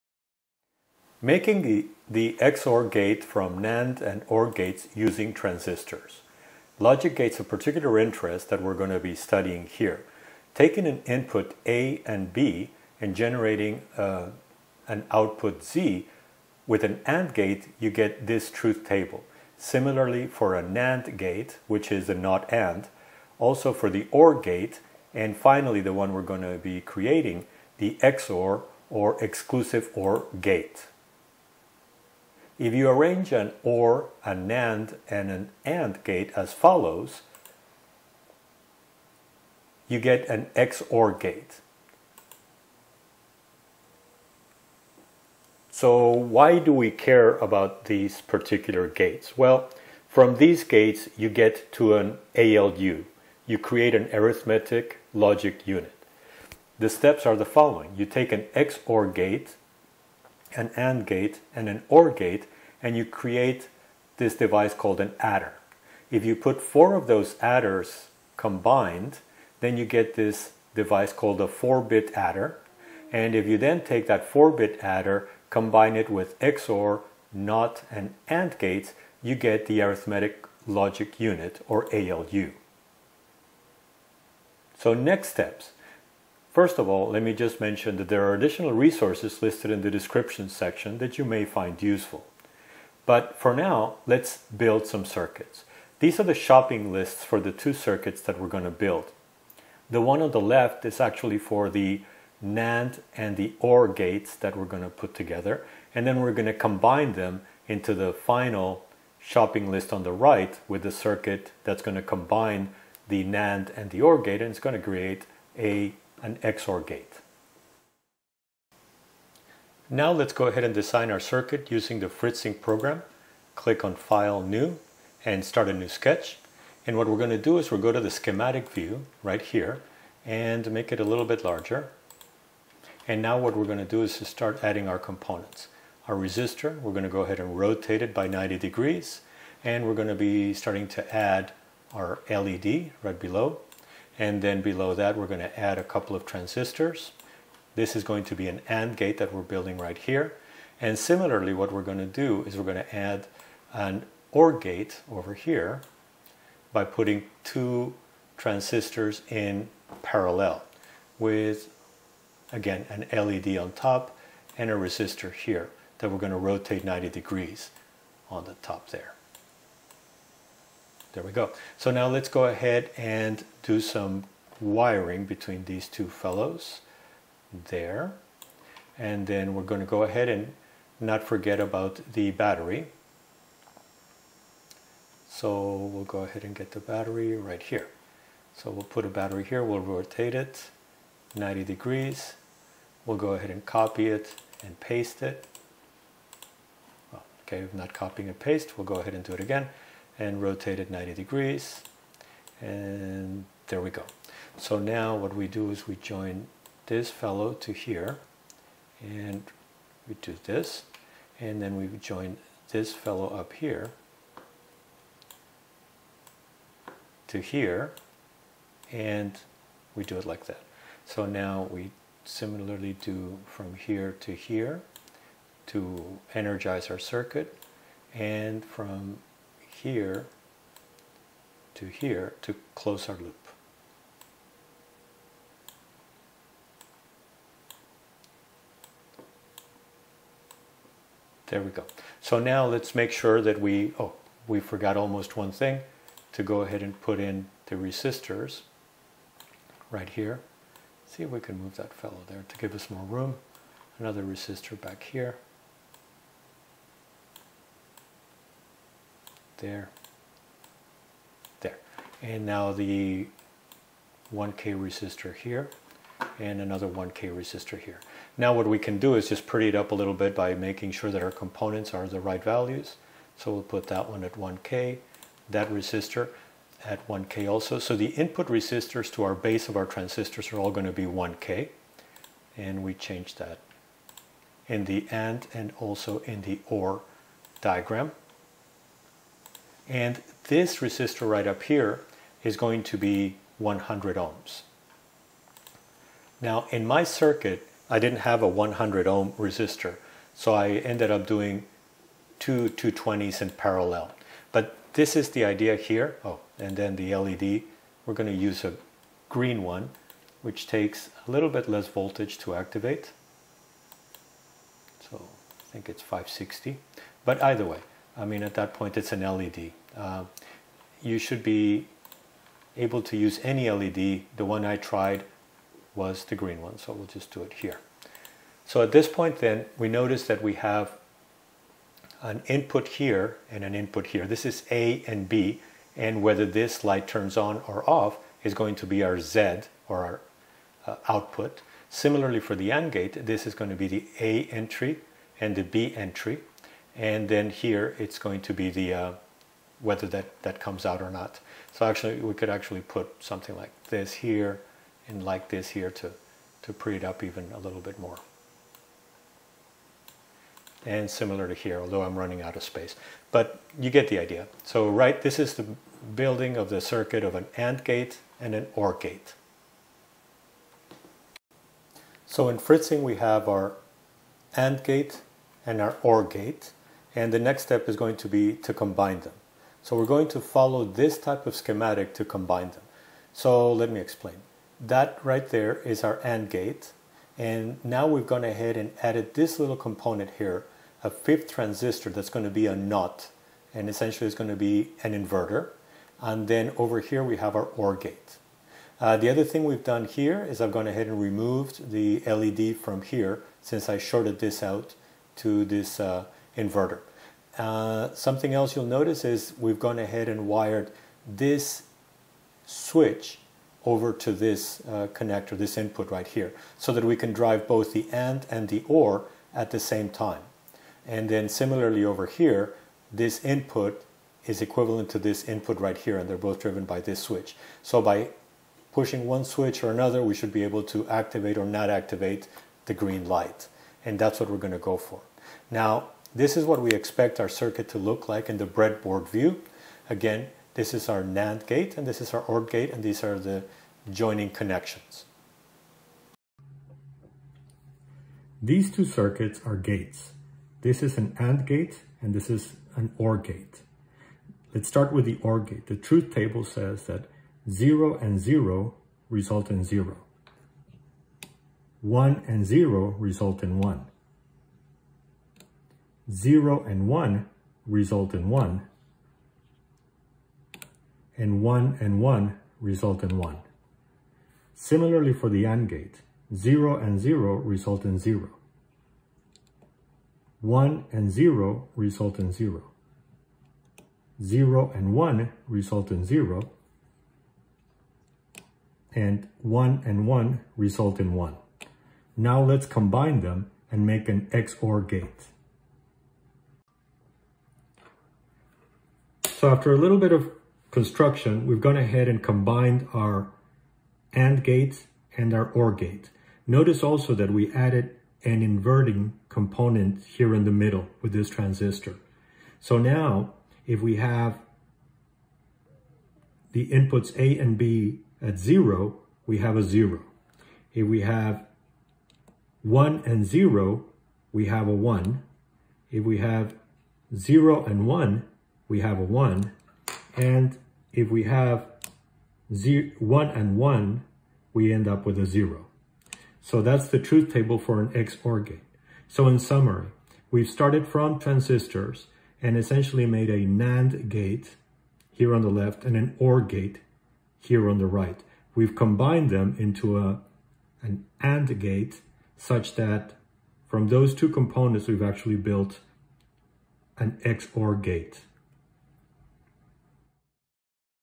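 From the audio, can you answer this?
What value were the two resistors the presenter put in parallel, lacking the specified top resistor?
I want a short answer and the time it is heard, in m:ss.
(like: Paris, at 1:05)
220, at 5:02.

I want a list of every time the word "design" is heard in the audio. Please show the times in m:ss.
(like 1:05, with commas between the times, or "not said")
2:00.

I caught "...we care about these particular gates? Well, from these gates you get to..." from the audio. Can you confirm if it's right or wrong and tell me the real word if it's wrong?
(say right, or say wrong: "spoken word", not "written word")
right.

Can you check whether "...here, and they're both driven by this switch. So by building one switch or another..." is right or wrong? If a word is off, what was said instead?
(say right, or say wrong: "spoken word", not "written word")
wrong: "pushing", not "building".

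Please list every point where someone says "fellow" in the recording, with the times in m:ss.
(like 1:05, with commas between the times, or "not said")
2:56, 3:27, 3:32, 4:11.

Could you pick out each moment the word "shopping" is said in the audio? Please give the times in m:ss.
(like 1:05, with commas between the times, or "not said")
1:36, 1:49.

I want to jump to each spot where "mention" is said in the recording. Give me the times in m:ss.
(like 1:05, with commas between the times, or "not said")
1:27.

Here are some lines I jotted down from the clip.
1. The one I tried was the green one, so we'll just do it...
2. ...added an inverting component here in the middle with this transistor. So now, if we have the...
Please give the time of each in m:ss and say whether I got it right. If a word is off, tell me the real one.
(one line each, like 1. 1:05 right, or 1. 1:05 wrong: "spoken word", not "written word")
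1. 5:24 right
2. 8:27 right.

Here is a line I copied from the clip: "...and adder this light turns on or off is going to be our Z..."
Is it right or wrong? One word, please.
wrong.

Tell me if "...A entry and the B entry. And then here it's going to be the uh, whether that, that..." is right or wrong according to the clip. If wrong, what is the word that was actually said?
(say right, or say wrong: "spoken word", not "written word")
right.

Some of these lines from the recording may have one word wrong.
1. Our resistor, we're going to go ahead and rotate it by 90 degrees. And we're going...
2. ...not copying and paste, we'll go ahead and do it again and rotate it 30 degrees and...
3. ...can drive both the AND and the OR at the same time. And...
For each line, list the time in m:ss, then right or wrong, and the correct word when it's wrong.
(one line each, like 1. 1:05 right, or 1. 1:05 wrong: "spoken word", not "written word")
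1. 2:16 right
2. 3:17 wrong: "90", not "30"
3. 6:57 right.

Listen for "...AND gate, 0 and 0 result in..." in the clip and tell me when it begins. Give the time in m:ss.
7:55.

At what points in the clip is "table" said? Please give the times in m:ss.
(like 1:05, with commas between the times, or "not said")
0:18, 7:36, 8:57.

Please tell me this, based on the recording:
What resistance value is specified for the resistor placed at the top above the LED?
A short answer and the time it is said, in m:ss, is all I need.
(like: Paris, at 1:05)
100 ohms, at 4:53.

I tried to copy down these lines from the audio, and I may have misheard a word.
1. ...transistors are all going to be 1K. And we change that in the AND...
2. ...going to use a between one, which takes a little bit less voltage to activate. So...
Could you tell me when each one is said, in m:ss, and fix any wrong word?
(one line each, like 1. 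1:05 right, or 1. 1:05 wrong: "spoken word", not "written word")
1. 4:39 right
2. 5:08 wrong: "green", not "between".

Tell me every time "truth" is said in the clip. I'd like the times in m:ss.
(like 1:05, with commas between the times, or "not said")
0:18, 7:35, 8:57.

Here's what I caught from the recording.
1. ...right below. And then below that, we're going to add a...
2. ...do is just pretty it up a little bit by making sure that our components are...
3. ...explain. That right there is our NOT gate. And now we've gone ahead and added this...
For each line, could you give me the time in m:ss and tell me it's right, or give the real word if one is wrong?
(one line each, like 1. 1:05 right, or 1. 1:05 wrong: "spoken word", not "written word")
1. 2:23 right
2. 4:28 right
3. 6:23 wrong: "AND", not "NOT".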